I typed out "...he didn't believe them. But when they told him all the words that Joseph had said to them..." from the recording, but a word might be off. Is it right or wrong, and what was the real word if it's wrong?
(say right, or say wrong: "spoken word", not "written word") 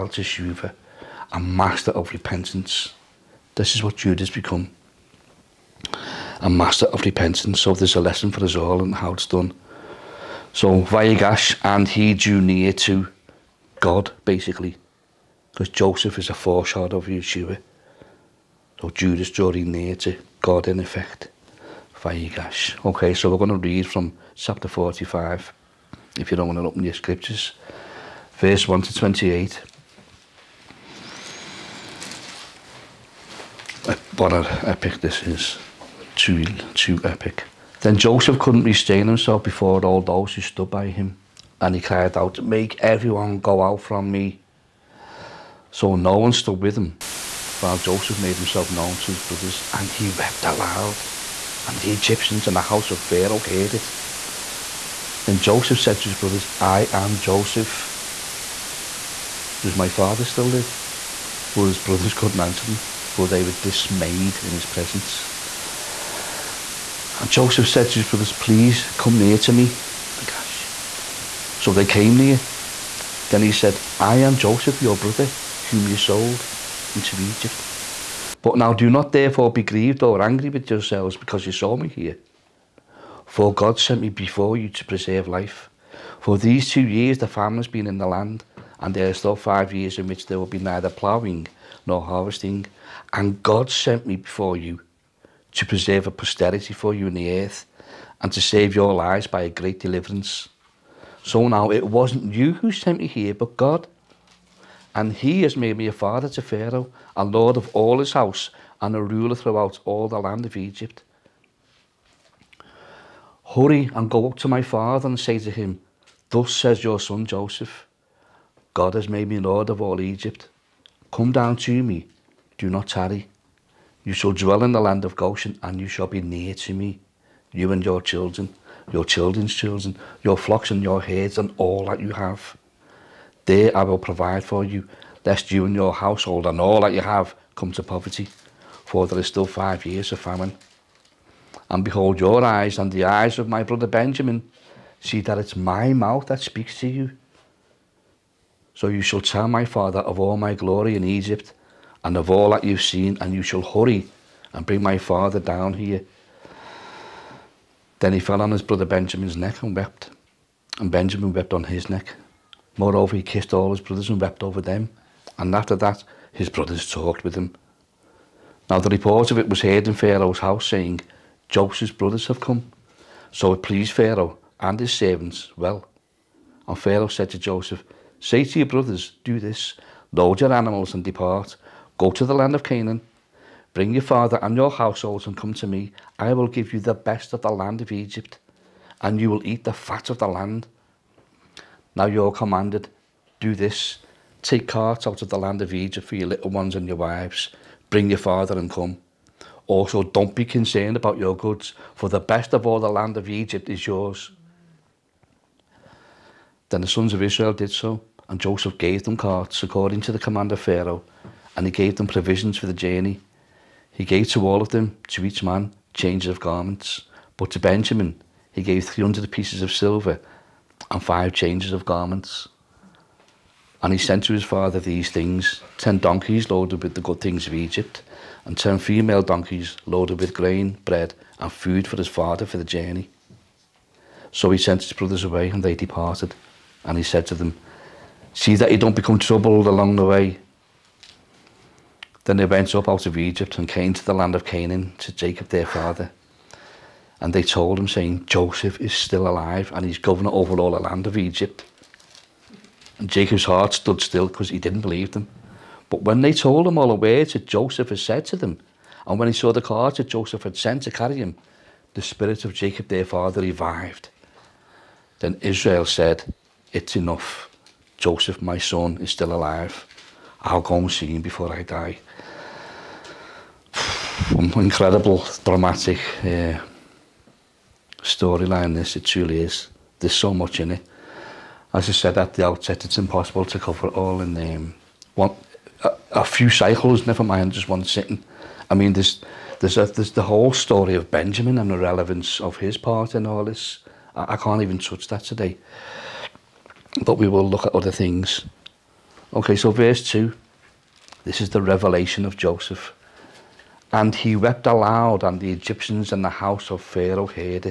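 right.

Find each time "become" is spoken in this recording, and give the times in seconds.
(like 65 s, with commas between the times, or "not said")
4 s, 238 s.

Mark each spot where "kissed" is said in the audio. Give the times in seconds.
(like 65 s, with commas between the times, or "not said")
163 s.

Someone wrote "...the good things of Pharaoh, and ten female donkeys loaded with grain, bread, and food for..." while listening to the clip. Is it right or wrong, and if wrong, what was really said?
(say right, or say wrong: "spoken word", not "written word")
wrong: "Egypt", not "Pharaoh".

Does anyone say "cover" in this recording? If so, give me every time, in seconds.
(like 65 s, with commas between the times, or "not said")
283 s.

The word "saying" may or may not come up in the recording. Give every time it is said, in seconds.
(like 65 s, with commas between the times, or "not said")
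170 s, 247 s.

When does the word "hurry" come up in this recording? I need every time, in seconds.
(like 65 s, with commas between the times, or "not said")
113 s, 153 s.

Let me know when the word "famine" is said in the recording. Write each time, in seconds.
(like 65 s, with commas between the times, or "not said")
87 s, 140 s.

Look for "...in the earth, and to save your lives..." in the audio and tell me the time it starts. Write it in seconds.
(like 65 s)
97 s.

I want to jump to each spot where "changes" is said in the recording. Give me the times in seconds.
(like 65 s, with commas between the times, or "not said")
215 s, 221 s.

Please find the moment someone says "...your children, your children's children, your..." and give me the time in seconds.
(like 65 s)
127 s.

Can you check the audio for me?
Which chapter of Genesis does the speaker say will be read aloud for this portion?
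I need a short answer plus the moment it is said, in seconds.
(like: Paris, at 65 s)
Chapter 45, at 24 s.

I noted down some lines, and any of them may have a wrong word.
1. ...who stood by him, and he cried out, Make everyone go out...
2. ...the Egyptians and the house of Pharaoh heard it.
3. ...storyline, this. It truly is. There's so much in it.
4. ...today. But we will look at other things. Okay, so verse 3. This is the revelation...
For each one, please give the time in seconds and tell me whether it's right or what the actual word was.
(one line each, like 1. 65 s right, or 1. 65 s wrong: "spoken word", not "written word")
1. 40 s right
2. 51 s right
3. 278 s right
4. 295 s wrong: "2", not "3".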